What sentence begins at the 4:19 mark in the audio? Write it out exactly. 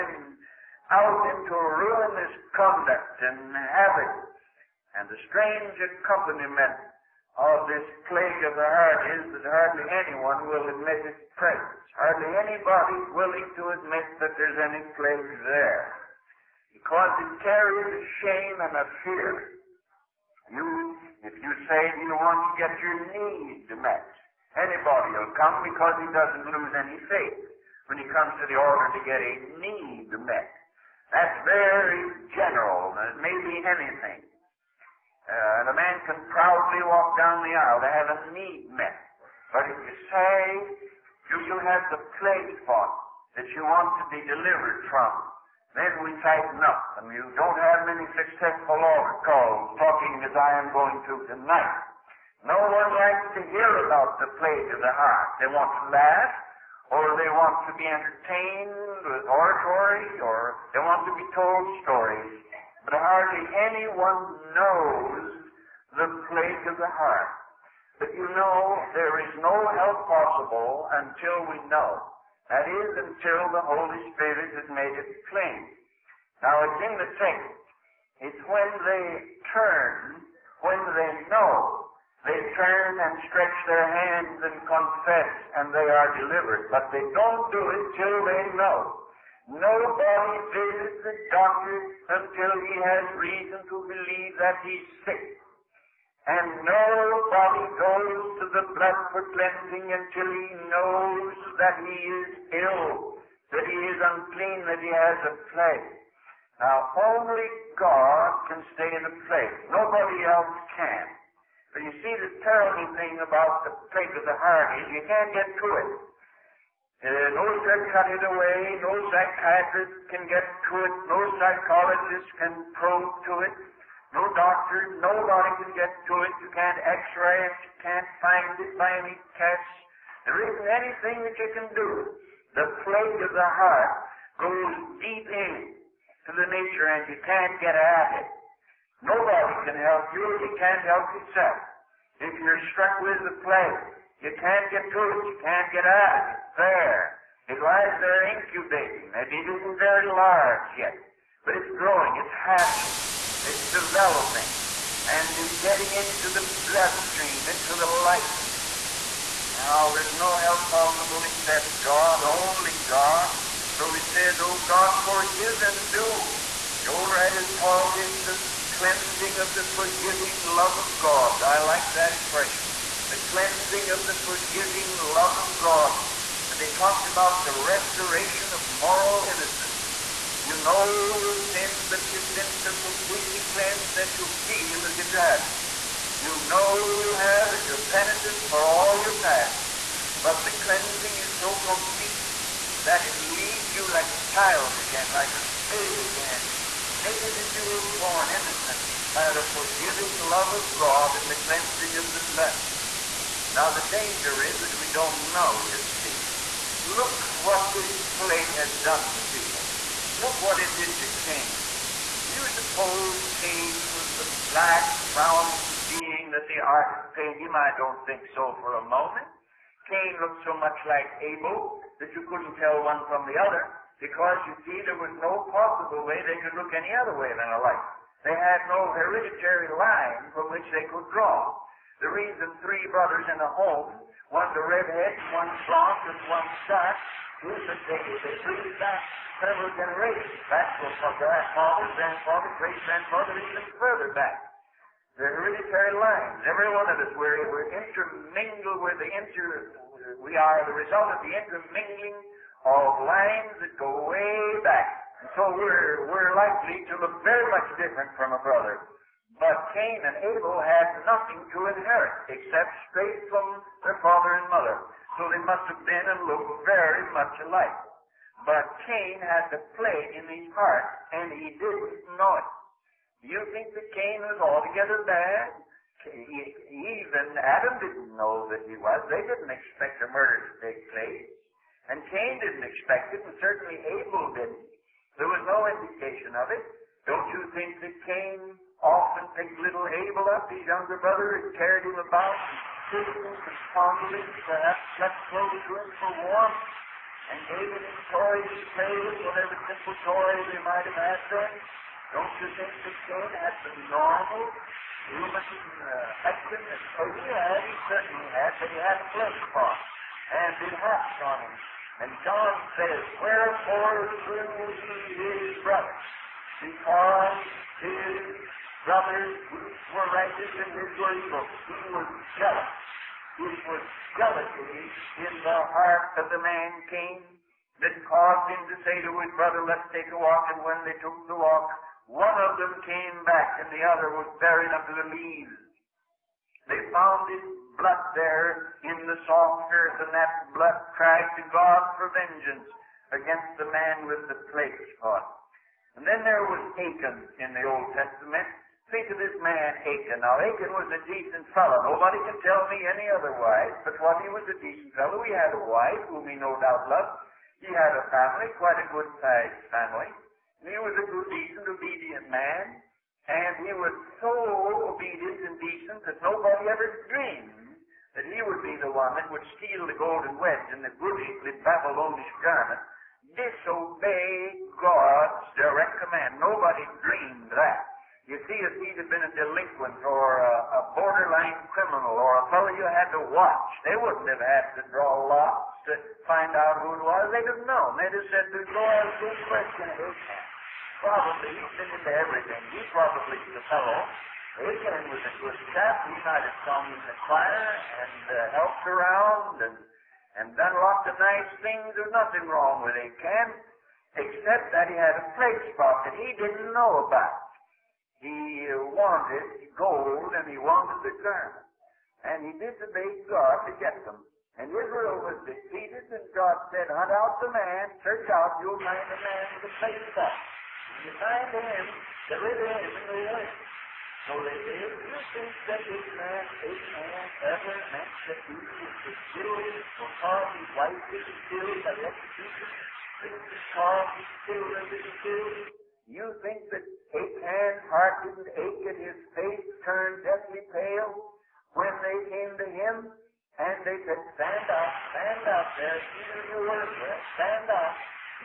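But Cain and Abel had nothing to inherit except straight from their father and mother.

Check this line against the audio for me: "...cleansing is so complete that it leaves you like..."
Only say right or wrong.
right.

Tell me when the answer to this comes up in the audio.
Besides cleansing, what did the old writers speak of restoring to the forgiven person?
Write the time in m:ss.
2:58.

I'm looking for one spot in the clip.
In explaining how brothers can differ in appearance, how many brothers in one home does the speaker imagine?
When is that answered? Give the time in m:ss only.
3:52.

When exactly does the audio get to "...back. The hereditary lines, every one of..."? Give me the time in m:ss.
4:04.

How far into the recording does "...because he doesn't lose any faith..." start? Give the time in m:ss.
0:25.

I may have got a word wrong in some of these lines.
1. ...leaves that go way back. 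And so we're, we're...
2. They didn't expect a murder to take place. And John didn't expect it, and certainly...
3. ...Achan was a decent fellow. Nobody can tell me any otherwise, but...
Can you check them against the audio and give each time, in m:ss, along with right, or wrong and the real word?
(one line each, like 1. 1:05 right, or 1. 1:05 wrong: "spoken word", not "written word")
1. 4:13 wrong: "lines", not "leaves"
2. 4:39 wrong: "Cain", not "John"
3. 5:50 right.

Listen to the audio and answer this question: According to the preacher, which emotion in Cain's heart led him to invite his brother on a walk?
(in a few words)
Jealousy.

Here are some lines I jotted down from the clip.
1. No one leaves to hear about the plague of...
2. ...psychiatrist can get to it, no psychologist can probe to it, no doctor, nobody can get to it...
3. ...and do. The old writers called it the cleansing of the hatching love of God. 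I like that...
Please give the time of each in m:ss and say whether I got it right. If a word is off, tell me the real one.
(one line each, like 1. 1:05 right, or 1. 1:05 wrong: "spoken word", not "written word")
1. 0:52 wrong: "likes", not "leaves"
2. 1:59 right
3. 2:45 wrong: "forgiving", not "hatching".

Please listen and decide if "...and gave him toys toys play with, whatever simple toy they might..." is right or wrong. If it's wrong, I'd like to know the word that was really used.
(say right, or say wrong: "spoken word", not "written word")
right.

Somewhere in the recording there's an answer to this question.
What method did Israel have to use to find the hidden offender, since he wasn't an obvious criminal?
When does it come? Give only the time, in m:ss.
6:24.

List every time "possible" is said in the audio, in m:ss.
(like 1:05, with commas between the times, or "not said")
1:10, 2:40, 3:45.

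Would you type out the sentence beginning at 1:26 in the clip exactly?
But they don't do it till they know.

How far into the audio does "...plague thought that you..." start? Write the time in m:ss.
0:42.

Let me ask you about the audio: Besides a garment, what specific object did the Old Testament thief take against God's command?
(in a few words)
Golden wedge.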